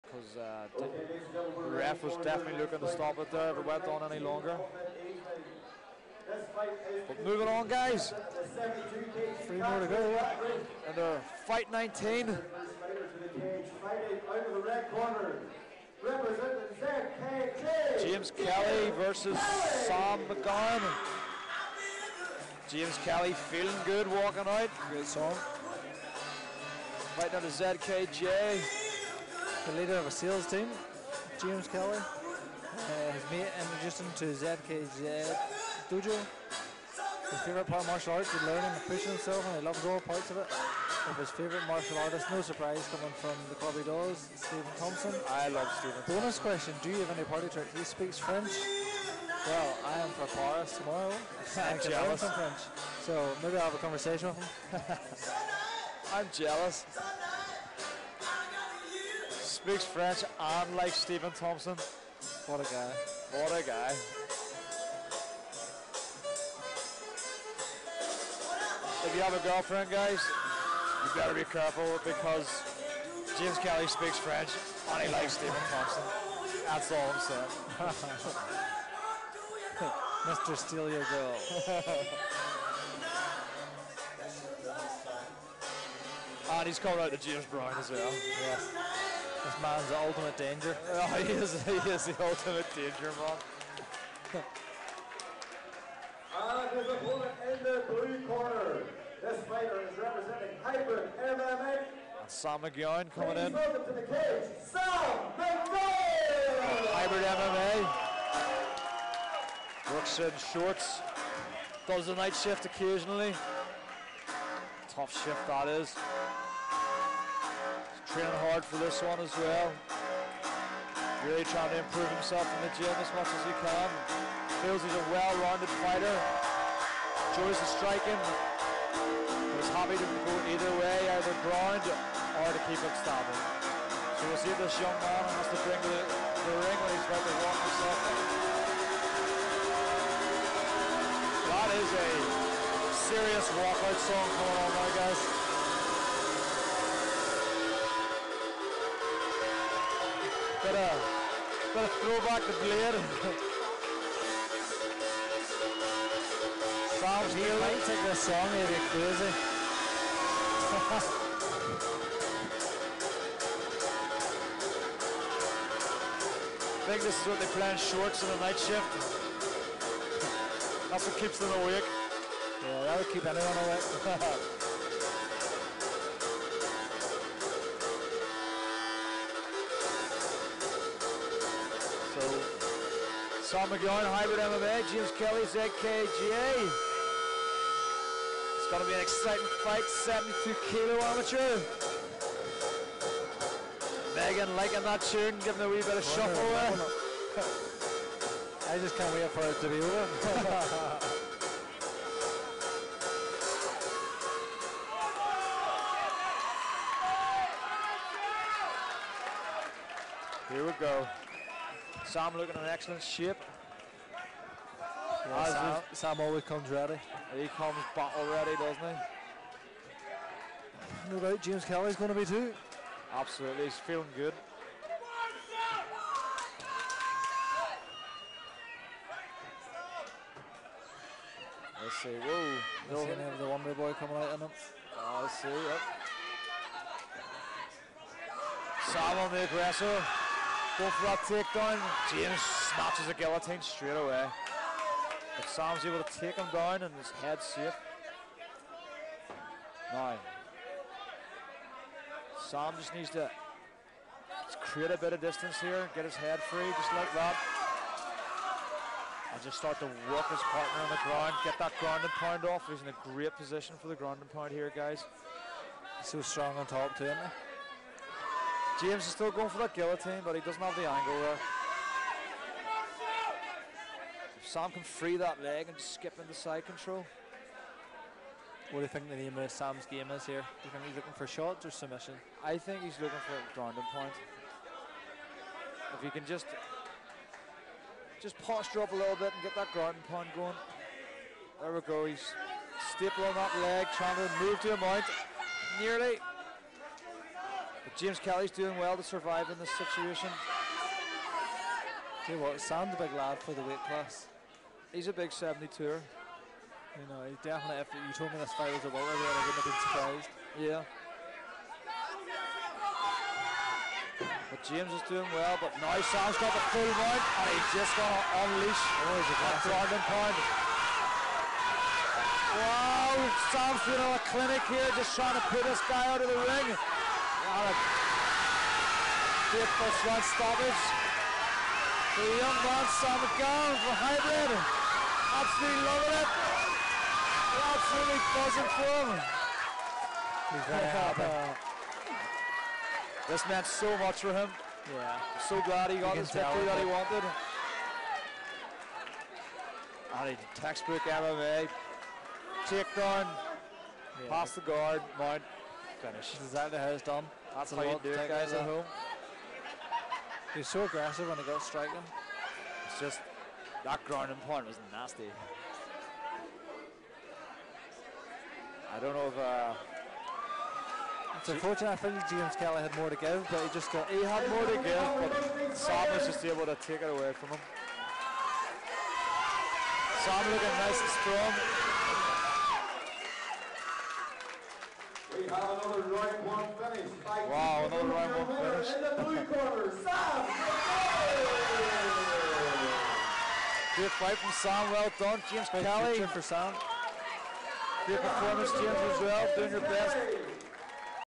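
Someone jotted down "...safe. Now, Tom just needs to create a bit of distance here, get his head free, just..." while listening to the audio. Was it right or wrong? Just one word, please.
wrong.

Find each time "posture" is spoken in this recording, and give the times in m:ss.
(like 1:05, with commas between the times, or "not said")
4:48.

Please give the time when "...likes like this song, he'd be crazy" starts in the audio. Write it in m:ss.
2:37.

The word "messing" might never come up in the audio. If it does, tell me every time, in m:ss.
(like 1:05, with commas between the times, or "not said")
not said.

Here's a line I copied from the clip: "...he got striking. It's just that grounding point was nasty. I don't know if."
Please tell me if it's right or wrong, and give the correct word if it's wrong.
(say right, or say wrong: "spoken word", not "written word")
right.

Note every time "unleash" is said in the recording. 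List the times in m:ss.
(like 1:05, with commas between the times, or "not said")
5:18.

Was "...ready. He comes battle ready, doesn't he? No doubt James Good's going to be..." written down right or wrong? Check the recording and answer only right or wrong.
wrong.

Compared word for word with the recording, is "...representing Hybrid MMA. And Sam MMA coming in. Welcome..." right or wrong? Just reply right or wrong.
wrong.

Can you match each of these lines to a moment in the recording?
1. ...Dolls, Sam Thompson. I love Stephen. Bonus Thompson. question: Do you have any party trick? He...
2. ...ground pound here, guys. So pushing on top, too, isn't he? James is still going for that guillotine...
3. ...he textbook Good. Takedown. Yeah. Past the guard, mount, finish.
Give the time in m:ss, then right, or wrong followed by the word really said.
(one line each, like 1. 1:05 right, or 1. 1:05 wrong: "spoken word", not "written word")
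1. 0:43 wrong: "Stephen", not "Sam"
2. 4:23 wrong: "strong", not "pushing"
3. 5:50 wrong: "MMA", not "Good".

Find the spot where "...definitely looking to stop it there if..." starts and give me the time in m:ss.
0:02.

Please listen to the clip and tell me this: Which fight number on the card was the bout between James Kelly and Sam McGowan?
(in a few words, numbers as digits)
19.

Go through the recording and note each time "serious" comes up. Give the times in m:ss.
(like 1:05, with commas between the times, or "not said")
2:23.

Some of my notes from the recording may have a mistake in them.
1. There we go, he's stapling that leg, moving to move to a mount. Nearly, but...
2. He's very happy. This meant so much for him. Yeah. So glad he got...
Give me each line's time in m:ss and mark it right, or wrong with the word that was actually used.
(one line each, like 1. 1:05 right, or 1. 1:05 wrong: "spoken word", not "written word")
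1. 4:51 wrong: "trying", not "moving"
2. 5:40 right.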